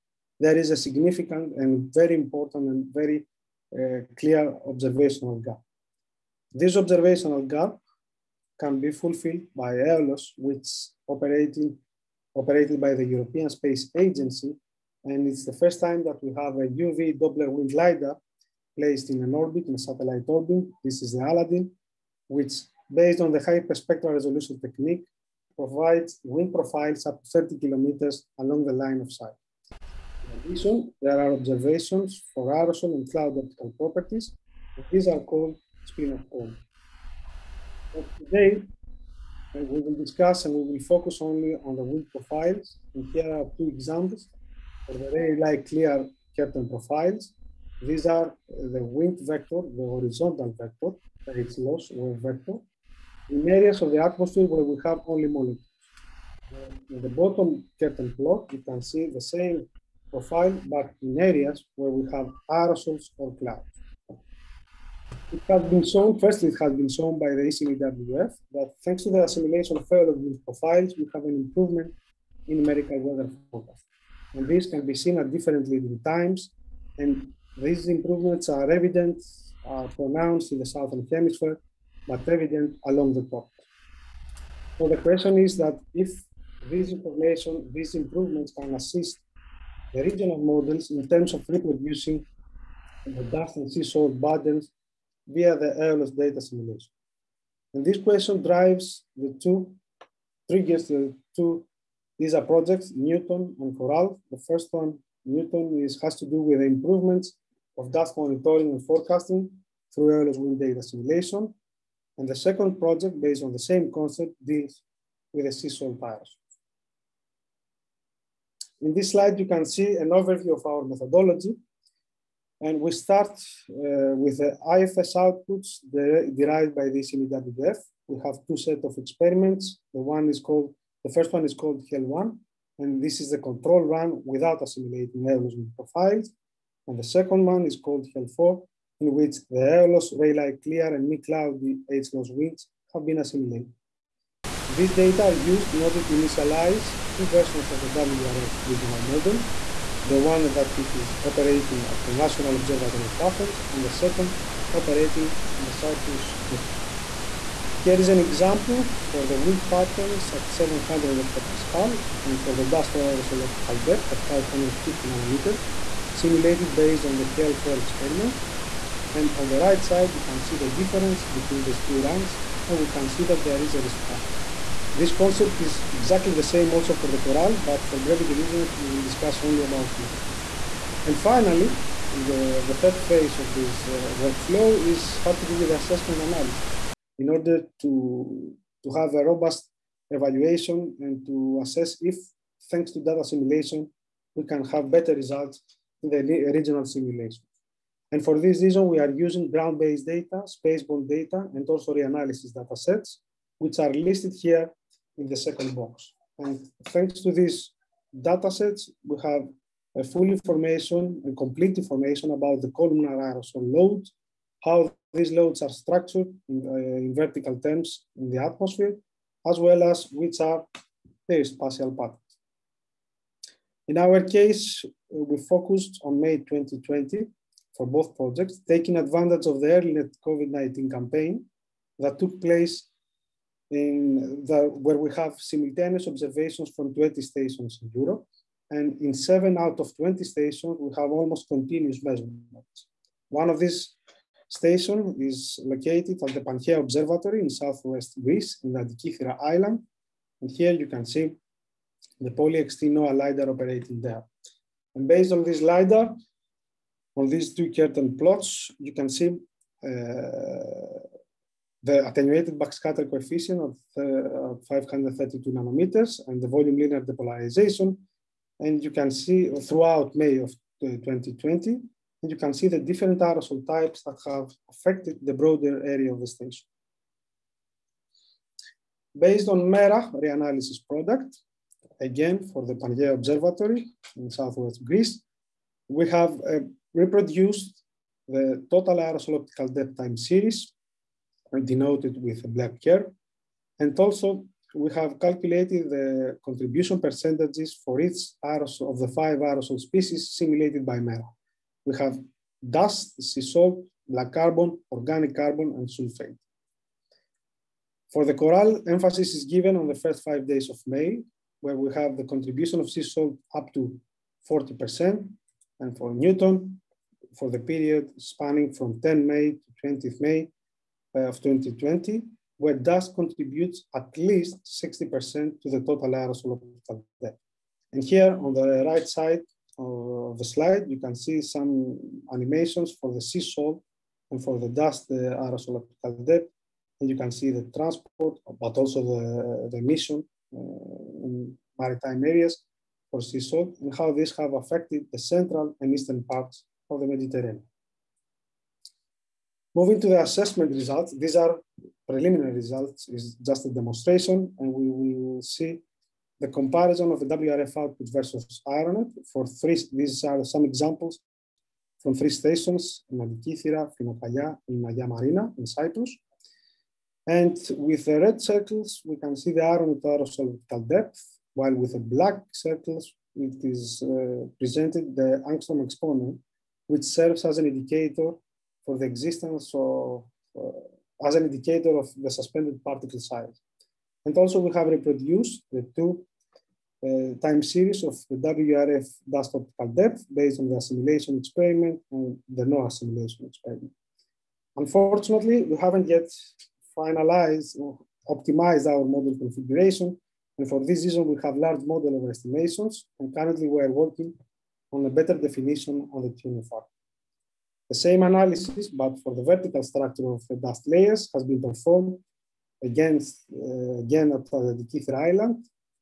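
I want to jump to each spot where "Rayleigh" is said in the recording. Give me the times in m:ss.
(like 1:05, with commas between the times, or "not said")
0:45, 2:20.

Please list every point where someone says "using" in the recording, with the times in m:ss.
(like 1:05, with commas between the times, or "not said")
3:19.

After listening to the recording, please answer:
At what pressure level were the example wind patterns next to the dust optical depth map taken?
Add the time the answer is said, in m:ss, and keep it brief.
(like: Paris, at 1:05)
700 hectopascal, at 2:40.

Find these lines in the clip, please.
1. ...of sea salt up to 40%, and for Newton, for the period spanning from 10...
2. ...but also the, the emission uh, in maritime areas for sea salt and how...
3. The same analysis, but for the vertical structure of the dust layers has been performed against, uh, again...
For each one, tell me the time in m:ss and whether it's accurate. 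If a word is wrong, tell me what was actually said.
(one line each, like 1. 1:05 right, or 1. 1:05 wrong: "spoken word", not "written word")
1. 5:12 right
2. 5:38 right
3. 6:47 right.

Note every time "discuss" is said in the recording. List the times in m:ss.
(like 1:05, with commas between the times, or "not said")
0:40, 2:59.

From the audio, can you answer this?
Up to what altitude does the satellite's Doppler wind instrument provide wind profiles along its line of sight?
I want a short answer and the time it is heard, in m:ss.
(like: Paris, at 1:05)
30 kilometers, at 0:27.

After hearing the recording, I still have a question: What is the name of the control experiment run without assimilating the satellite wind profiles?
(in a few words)
HEL1.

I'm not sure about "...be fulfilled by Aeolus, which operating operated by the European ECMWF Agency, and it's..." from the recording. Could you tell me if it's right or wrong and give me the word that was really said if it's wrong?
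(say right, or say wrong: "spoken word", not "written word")
wrong: "Space", not "ECMWF".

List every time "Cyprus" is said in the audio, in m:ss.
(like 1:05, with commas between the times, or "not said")
2:35, 6:05.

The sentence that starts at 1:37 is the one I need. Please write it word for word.
And this question drives the two, triggers the two These are projects, Newton and Coral.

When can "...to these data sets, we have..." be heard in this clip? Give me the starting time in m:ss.
3:27.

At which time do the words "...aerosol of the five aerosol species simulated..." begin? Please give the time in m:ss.
4:58.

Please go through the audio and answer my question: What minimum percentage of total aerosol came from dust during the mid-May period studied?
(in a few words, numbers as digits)
60%.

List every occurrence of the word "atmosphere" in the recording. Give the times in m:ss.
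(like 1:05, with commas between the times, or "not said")
0:54, 3:38.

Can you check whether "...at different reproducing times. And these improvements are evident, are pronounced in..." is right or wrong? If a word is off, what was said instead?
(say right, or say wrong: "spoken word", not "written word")
wrong: "leading", not "reproducing".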